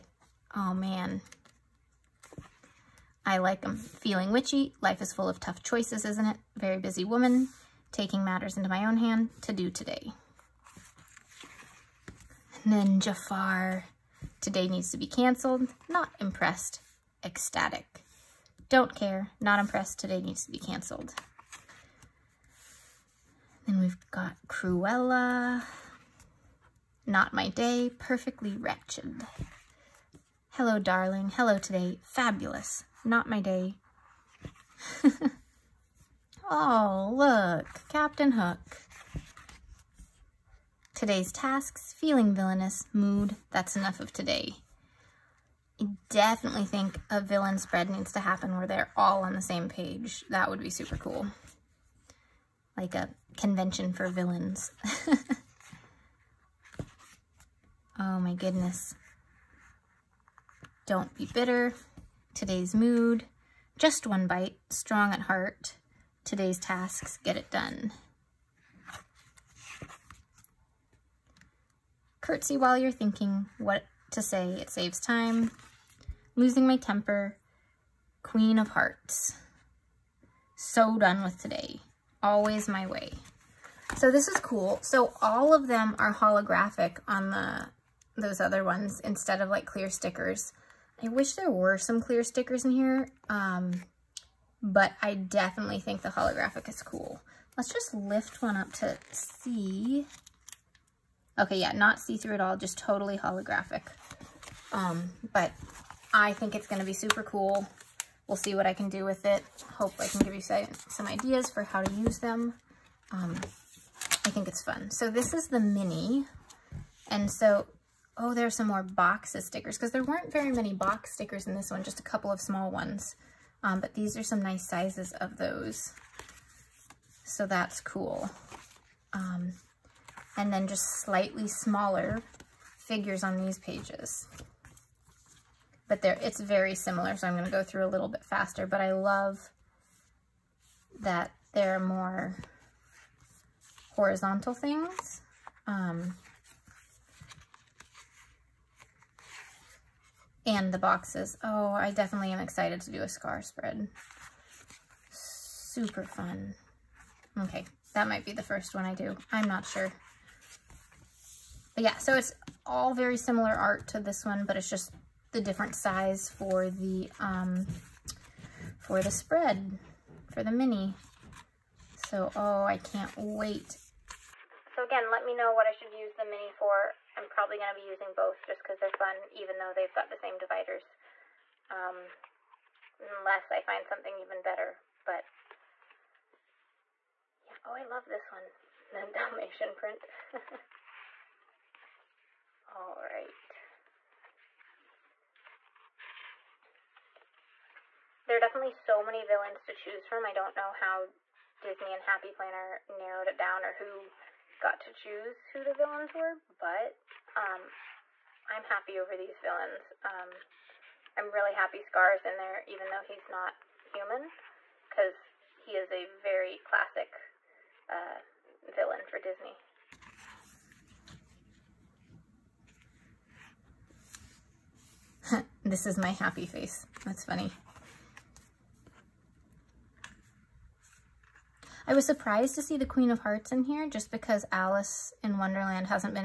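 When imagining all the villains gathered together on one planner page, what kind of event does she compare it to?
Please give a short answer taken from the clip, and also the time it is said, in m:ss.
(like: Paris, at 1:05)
A convention for villains, at 0:52.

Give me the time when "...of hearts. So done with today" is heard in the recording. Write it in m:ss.
1:18.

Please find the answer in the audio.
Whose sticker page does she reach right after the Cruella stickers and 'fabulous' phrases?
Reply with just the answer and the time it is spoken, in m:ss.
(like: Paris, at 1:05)
Captain Hook, at 0:37.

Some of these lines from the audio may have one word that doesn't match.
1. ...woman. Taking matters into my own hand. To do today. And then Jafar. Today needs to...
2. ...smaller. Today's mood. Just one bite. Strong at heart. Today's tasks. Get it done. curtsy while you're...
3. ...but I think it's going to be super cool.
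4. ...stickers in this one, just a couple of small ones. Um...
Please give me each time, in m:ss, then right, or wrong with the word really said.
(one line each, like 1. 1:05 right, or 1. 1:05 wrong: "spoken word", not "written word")
1. 0:07 right
2. 1:01 wrong: "bitter", not "smaller"
3. 1:45 right
4. 2:01 right.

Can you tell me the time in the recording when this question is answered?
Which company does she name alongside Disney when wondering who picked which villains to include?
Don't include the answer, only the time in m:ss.
3:22.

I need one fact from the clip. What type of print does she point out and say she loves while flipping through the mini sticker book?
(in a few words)
Dalmatian print.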